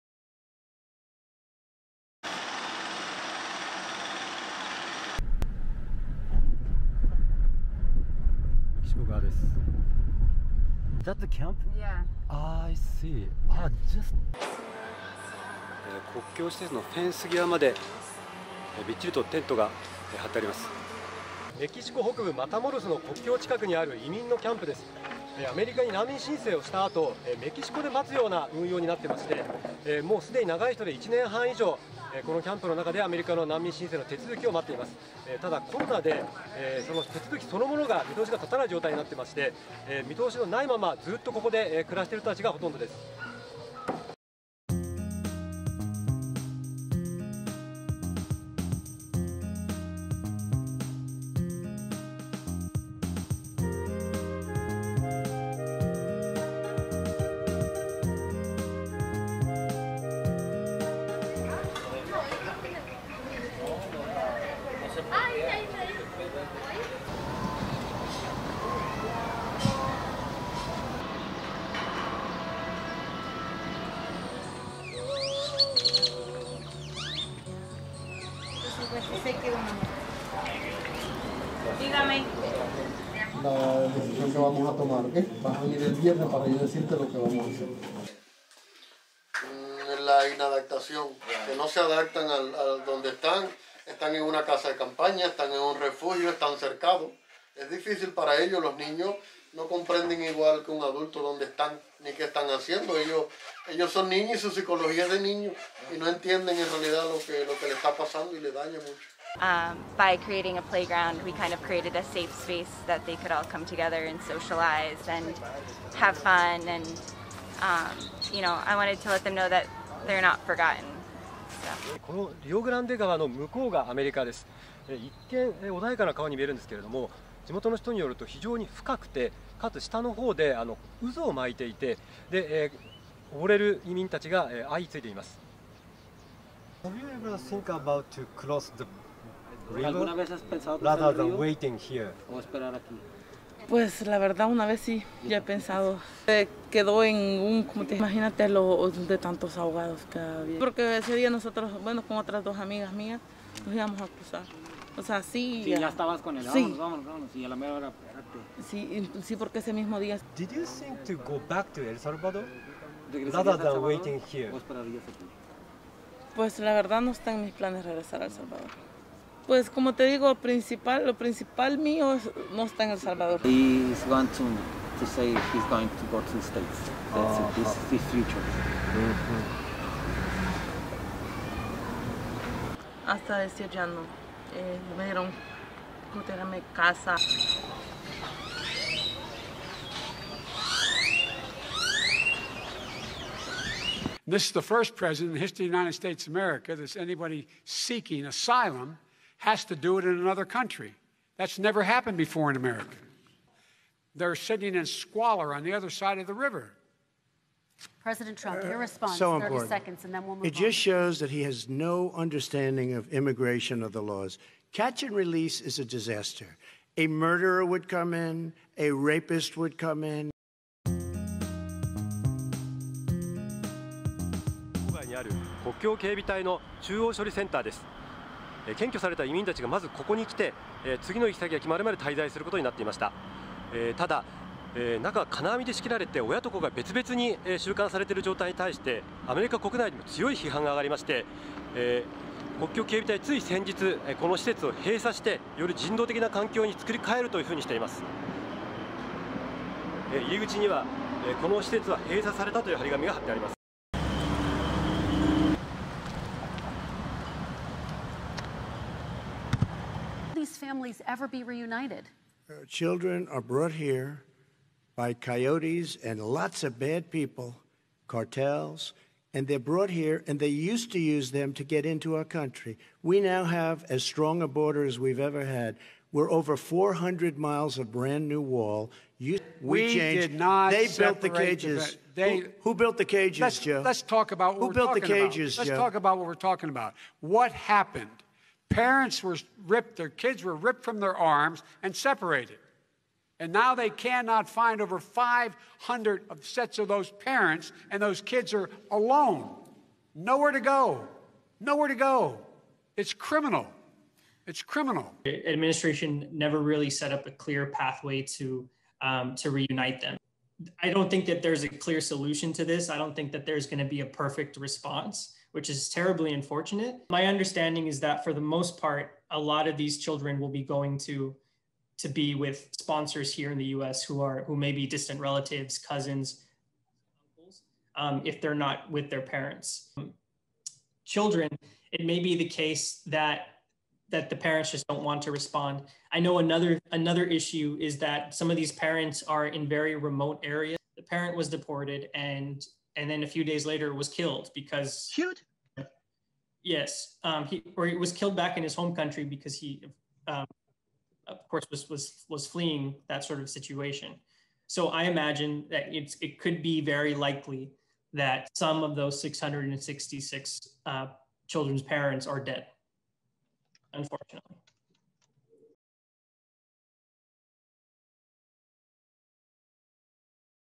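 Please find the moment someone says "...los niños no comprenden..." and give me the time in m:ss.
1:38.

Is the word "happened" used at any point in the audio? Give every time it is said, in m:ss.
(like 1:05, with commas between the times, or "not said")
3:21, 4:47.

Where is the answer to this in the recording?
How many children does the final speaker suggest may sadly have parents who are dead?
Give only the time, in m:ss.
5:59.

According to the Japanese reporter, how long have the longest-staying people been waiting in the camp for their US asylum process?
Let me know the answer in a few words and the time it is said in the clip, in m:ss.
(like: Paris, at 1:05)
Over 1.5 years, at 0:30.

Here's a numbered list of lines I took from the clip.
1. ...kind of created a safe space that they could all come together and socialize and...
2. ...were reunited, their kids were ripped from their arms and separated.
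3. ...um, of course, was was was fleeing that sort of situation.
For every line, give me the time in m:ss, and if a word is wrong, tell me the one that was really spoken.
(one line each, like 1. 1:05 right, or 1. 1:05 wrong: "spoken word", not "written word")
1. 1:51 right
2. 4:49 wrong: "ripped", not "reunited"
3. 5:50 right.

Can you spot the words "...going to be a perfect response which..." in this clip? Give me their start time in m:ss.
5:13.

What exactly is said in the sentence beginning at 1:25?
Vas a venir el viernes para yo decirte lo que vamos a hacer.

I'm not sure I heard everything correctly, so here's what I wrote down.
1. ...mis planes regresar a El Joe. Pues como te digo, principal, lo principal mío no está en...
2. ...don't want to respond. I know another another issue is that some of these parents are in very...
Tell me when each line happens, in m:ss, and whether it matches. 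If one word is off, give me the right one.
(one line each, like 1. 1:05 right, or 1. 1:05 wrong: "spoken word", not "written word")
1. 2:47 wrong: "Salvador", not "Joe"
2. 5:34 right.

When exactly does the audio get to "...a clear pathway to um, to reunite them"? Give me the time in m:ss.
5:07.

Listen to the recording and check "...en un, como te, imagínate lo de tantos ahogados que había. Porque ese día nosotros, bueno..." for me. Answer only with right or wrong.
right.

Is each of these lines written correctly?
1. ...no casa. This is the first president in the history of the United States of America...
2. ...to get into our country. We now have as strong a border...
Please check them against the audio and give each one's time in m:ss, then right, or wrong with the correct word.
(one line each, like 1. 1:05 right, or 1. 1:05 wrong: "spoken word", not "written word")
1. 3:06 right
2. 4:31 right.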